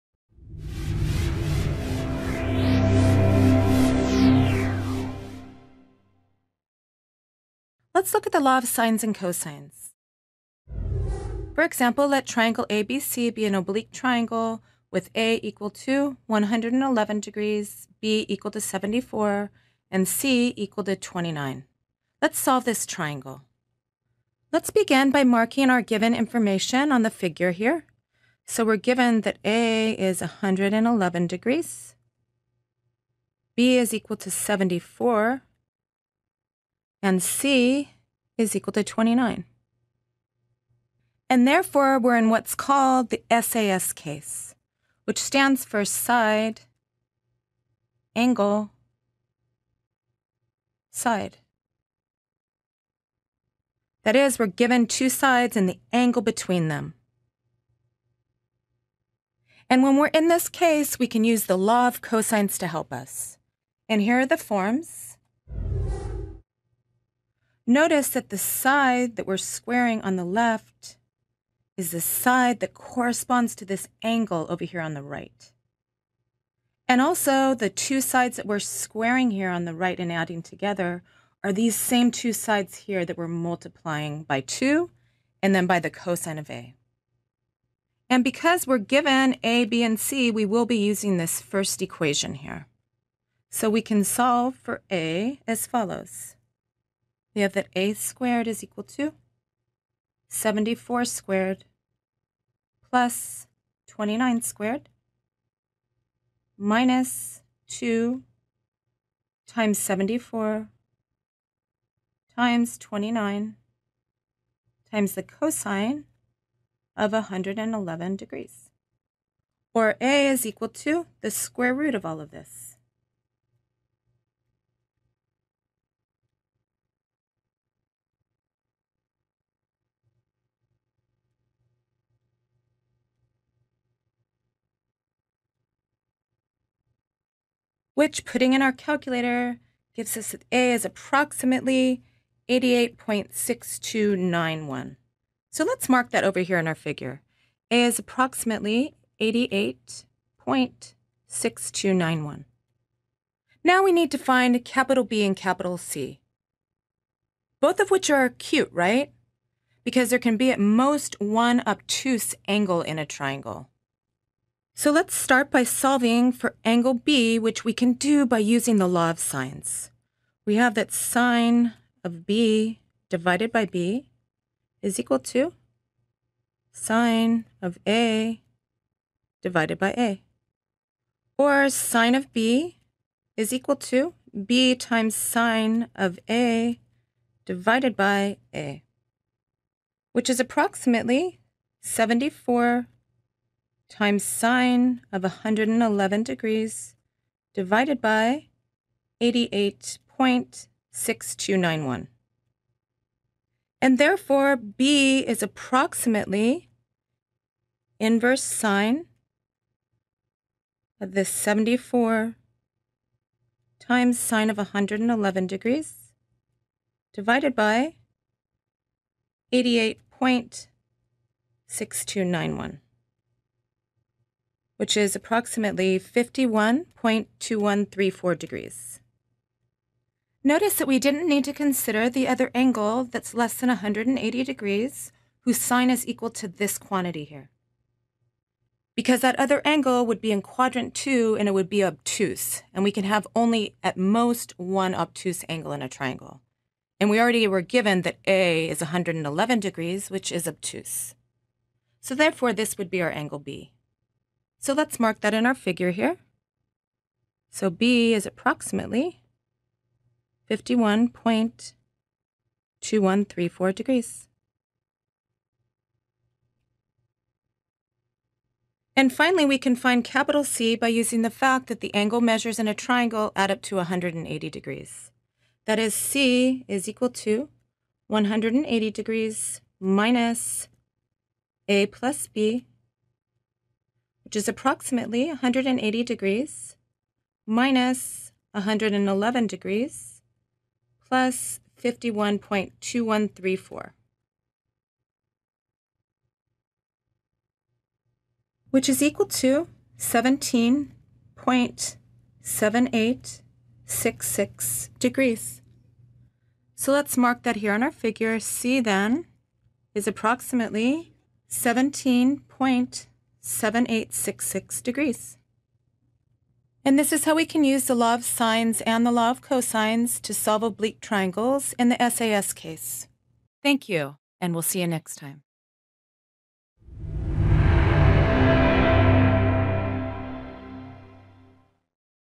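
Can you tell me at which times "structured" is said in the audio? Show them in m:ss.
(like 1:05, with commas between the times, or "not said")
not said.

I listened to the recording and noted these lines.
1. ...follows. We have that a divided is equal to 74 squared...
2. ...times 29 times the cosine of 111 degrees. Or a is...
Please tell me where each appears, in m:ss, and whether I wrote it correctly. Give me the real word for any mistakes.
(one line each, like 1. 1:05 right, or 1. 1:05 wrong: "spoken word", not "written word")
1. 1:35 wrong: "squared", not "divided"
2. 1:52 right.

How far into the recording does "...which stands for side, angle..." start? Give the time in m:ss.
0:45.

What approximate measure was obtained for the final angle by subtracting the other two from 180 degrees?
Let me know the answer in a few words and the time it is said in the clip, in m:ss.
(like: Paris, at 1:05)
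17.7866 degrees, at 4:59.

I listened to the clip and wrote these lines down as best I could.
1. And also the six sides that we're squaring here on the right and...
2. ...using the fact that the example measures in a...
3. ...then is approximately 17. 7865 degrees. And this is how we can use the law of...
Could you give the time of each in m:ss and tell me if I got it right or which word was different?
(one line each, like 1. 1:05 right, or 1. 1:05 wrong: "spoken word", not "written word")
1. 1:16 wrong: "two", not "six"
2. 4:30 wrong: "angle", not "example"
3. 5:08 wrong: "7866", not "7865".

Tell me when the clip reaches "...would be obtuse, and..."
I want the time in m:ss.
4:01.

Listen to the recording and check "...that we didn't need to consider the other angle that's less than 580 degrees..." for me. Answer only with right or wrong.
wrong.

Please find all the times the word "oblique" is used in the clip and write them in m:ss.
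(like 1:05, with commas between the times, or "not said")
0:13, 5:20.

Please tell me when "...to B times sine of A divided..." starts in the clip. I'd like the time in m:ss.
3:03.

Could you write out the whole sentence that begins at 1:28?
And because we're given A, B, and C, we will be using this first equation here.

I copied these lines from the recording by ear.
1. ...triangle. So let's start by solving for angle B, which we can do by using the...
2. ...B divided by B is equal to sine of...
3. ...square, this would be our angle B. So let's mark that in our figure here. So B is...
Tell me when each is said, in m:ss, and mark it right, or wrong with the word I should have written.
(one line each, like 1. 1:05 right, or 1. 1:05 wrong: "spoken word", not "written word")
1. 2:43 right
2. 2:52 right
3. 4:12 wrong: "therefore", not "square".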